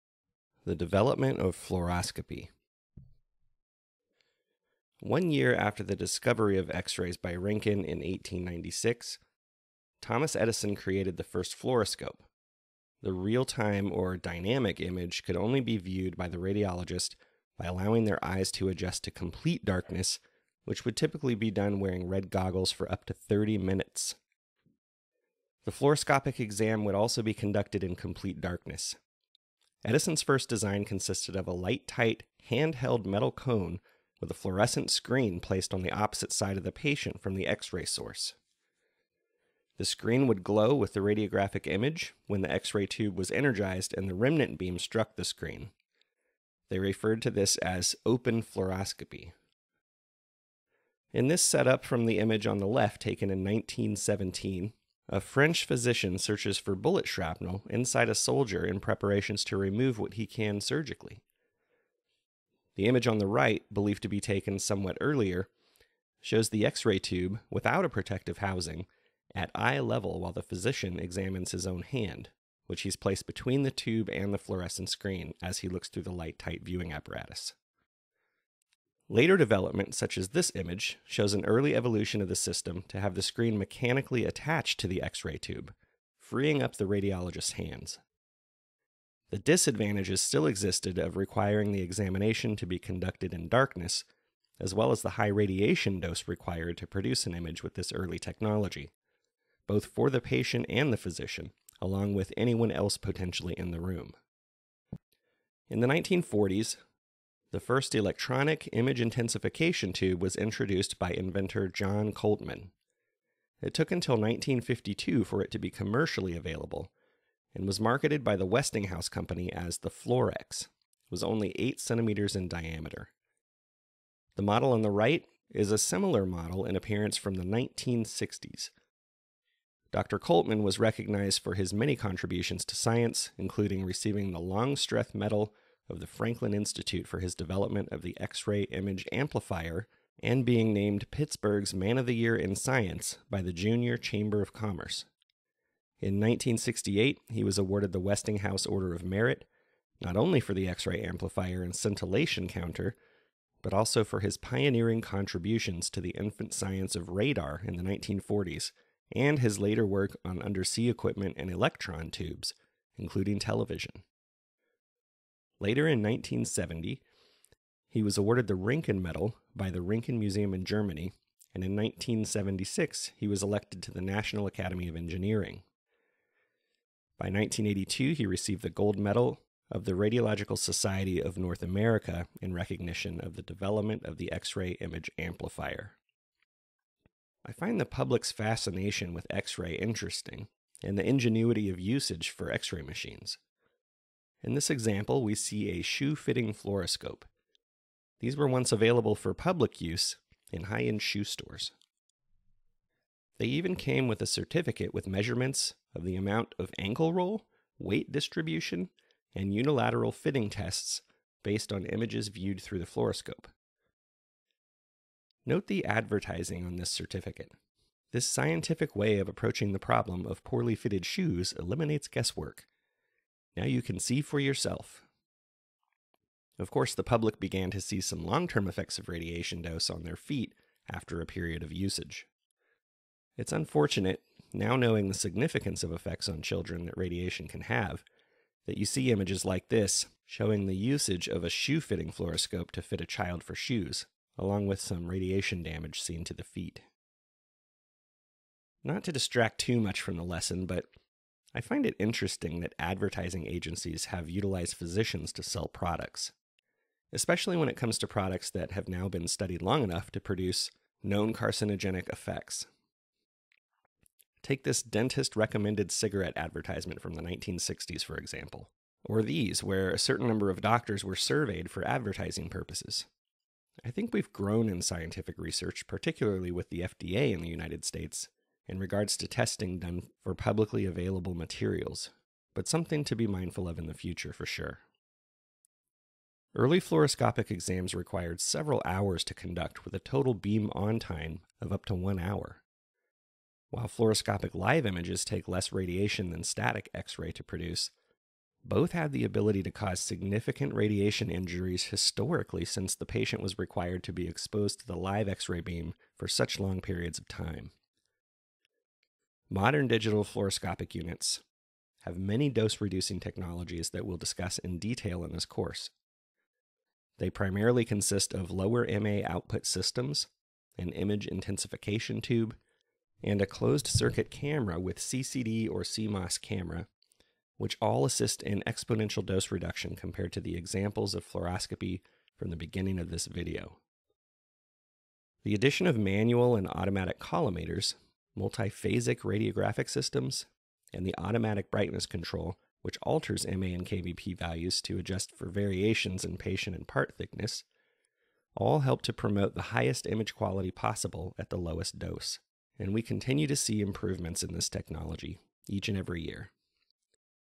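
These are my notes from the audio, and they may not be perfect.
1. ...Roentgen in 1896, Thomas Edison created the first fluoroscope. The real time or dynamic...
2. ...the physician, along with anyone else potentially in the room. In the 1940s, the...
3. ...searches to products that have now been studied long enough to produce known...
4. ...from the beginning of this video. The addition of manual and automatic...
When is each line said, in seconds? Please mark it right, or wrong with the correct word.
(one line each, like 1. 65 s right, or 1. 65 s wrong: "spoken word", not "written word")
1. 7 s right
2. 100 s right
3. 257 s wrong: "comes", not "searches"
4. 332 s right.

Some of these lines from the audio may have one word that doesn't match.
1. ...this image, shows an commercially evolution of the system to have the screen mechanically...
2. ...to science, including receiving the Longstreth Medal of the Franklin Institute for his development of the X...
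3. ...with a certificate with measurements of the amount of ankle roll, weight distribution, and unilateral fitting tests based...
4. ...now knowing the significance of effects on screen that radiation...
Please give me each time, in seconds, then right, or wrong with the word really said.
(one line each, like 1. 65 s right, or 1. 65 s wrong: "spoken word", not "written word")
1. 80 s wrong: "early", not "commercially"
2. 132 s right
3. 204 s right
4. 234 s wrong: "children", not "screen".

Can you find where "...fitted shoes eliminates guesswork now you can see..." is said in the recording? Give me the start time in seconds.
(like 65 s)
220 s.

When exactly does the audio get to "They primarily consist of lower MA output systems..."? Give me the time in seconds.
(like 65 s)
317 s.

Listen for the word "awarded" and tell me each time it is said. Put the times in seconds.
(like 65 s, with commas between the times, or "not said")
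147 s, 168 s.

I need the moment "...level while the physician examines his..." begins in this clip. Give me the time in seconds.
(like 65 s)
69 s.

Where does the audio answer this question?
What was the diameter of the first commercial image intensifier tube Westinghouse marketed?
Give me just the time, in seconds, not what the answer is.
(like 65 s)
121 s.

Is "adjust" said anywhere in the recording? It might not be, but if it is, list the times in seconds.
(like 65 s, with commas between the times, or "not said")
18 s, 344 s.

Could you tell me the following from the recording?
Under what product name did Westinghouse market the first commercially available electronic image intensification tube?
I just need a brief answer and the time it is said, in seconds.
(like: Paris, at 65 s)
Florex, at 119 s.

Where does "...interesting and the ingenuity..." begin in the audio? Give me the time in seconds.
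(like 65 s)
189 s.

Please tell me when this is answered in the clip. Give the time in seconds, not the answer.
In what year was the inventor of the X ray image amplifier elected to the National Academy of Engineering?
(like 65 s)
171 s.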